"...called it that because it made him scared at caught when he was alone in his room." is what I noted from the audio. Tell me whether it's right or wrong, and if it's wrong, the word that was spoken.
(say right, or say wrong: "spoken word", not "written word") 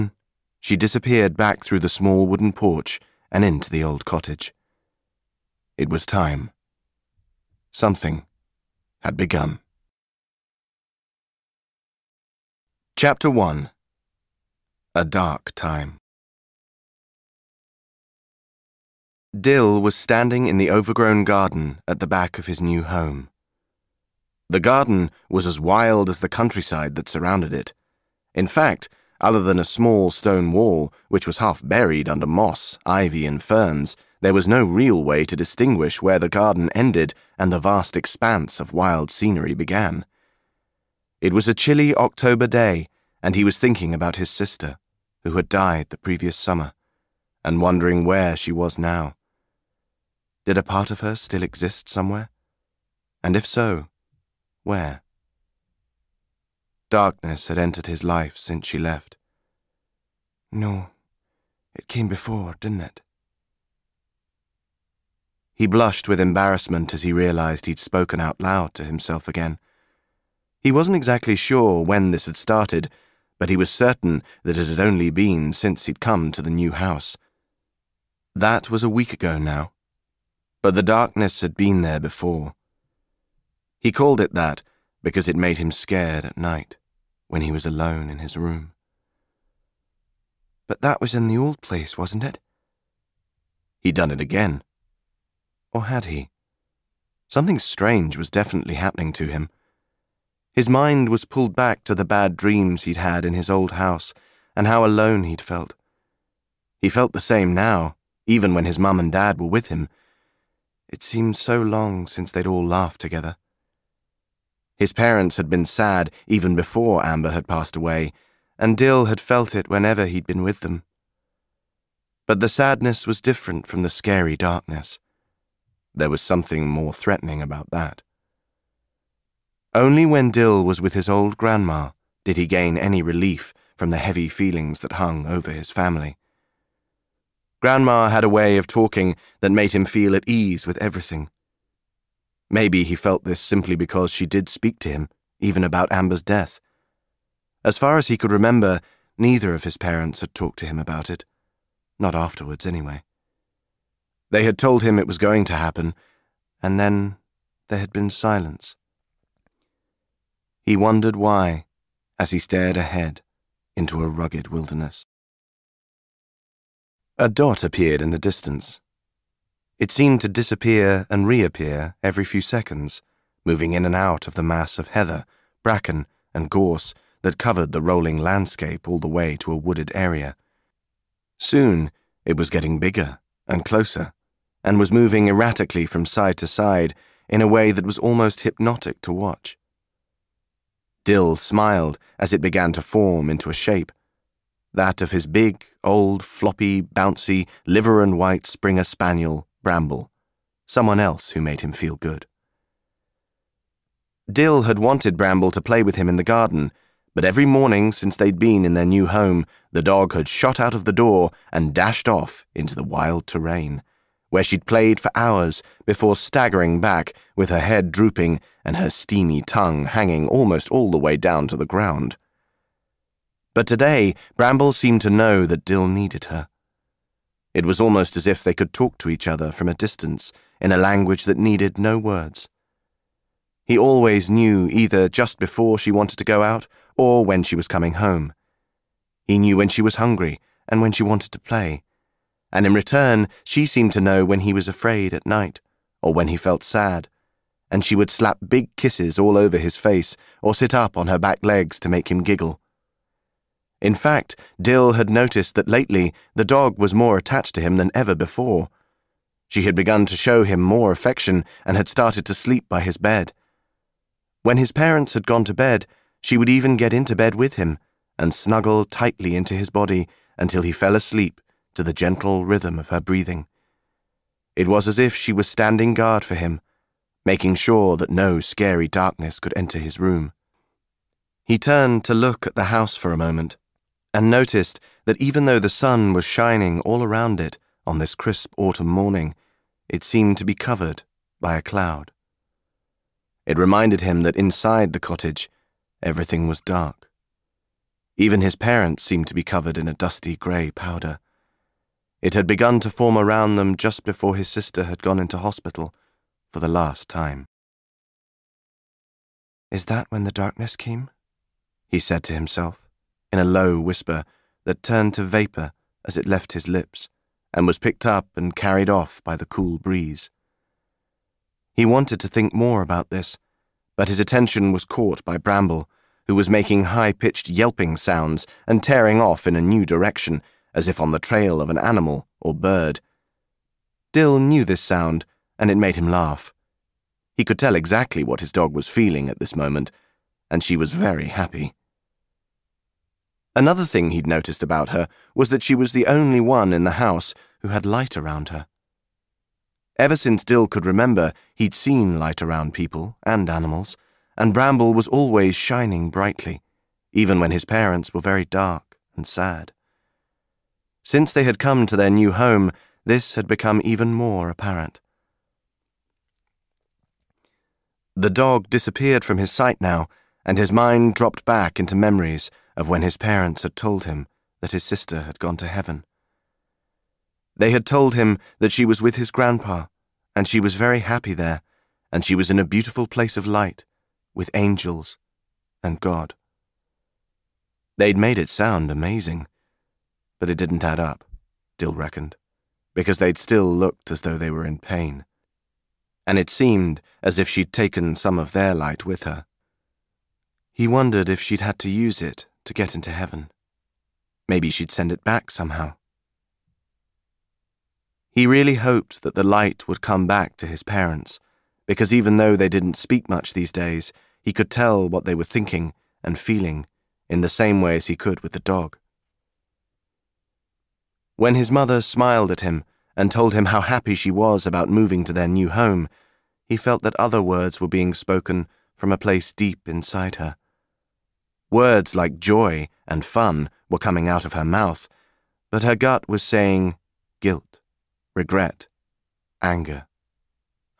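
wrong: "night", not "caught".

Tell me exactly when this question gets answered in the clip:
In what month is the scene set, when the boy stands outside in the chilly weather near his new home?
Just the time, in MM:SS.
00:41.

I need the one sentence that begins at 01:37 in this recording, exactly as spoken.
Something strange was definitely happening to him.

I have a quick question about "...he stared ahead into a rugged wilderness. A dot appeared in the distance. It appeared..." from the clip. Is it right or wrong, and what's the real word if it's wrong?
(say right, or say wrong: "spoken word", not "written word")
wrong: "seemed", not "appeared".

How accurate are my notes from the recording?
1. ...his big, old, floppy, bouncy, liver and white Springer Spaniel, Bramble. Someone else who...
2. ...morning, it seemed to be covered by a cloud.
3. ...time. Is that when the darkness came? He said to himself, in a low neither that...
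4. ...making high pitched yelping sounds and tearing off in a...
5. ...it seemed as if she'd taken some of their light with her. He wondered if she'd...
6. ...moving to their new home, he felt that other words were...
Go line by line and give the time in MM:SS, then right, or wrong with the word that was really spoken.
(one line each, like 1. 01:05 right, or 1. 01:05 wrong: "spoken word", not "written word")
1. 03:15 right
2. 04:48 right
3. 05:07 wrong: "whisper", not "neither"
4. 05:26 right
5. 06:36 right
6. 07:04 right.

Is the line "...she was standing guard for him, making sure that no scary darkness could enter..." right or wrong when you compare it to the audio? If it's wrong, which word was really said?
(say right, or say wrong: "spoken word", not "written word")
right.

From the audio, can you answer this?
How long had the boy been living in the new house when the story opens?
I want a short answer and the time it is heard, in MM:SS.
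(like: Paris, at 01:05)
A week, at 01:18.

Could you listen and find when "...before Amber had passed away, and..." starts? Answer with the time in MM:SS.
01:56.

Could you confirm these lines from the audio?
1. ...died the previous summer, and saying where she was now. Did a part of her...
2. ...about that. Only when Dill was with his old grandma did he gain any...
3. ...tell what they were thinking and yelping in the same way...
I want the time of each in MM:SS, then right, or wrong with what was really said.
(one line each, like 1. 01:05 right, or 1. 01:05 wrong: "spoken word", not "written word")
1. 00:45 wrong: "wondering", not "saying"
2. 02:07 right
3. 06:54 wrong: "feeling", not "yelping".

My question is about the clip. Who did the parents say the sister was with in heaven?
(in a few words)
His grandpa.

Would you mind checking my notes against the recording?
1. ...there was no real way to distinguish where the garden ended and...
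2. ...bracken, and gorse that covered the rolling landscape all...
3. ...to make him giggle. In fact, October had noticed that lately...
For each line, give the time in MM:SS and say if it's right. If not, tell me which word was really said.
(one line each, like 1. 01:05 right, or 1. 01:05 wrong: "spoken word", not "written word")
1. 00:34 right
2. 02:55 right
3. 04:11 wrong: "Dill", not "October".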